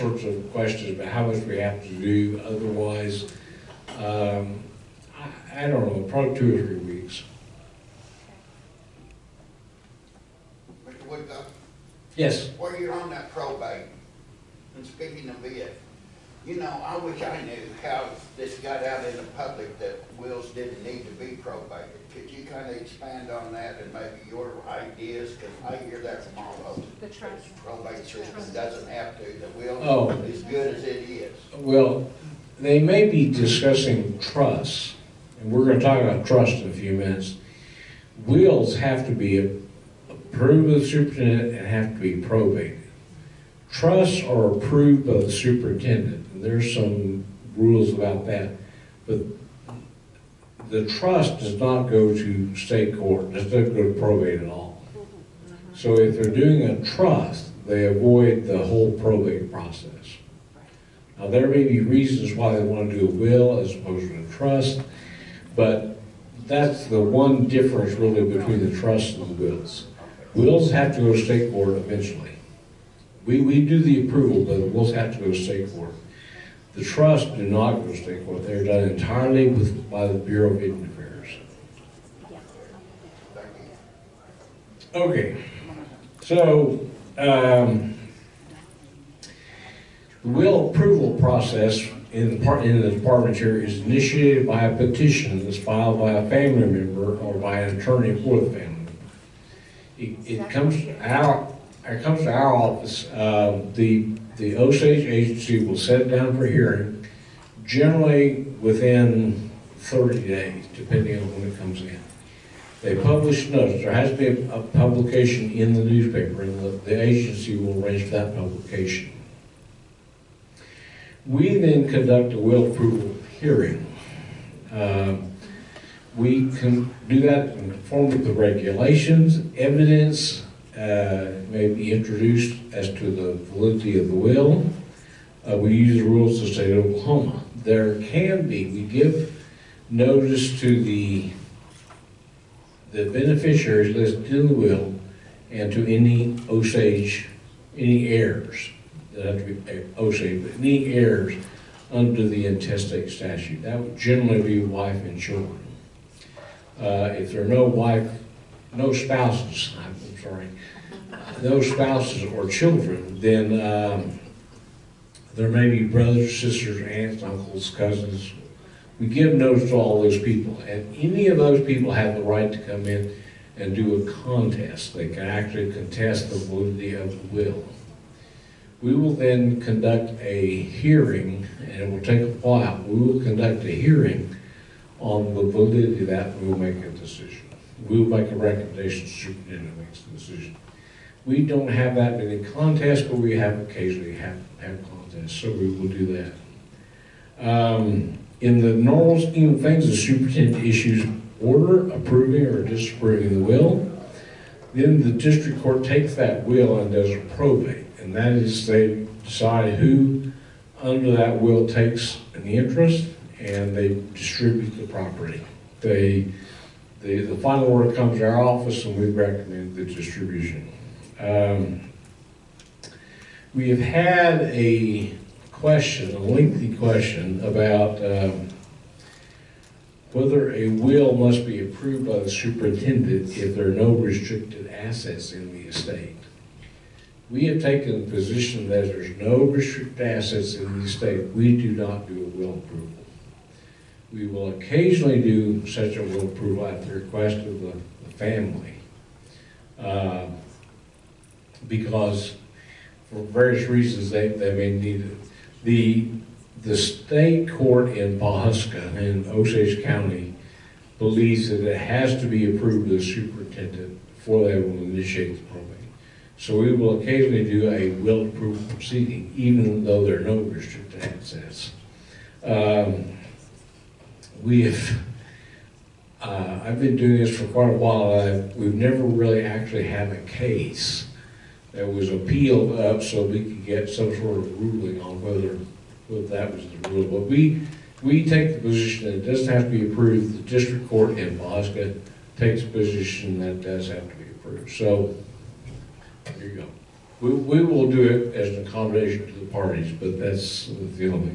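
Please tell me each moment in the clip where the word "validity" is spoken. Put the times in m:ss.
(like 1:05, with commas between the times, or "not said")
2:13, 2:56, 3:05.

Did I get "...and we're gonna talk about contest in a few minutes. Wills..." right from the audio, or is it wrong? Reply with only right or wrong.
wrong.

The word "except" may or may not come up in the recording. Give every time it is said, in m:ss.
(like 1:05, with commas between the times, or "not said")
not said.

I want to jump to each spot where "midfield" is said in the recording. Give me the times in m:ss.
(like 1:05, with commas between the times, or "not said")
not said.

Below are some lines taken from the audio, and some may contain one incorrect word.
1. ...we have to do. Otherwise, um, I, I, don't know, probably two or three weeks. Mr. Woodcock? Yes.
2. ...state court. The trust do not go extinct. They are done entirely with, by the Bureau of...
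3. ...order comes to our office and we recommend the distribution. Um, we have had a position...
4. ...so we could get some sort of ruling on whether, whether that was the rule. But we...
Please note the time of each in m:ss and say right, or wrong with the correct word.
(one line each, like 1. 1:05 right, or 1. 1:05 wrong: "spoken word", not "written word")
1. 0:01 right
2. 1:15 right
3. 3:37 wrong: "question", not "position"
4. 4:43 right.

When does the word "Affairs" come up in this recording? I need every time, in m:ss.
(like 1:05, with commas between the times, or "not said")
1:20.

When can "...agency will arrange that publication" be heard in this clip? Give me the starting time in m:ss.
1:57.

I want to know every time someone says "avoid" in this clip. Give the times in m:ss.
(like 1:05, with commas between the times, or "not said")
0:57.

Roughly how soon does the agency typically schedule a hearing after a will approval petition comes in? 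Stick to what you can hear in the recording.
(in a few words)
within 30 days.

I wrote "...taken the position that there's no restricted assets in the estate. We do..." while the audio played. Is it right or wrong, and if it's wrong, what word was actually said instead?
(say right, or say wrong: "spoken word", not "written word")
right.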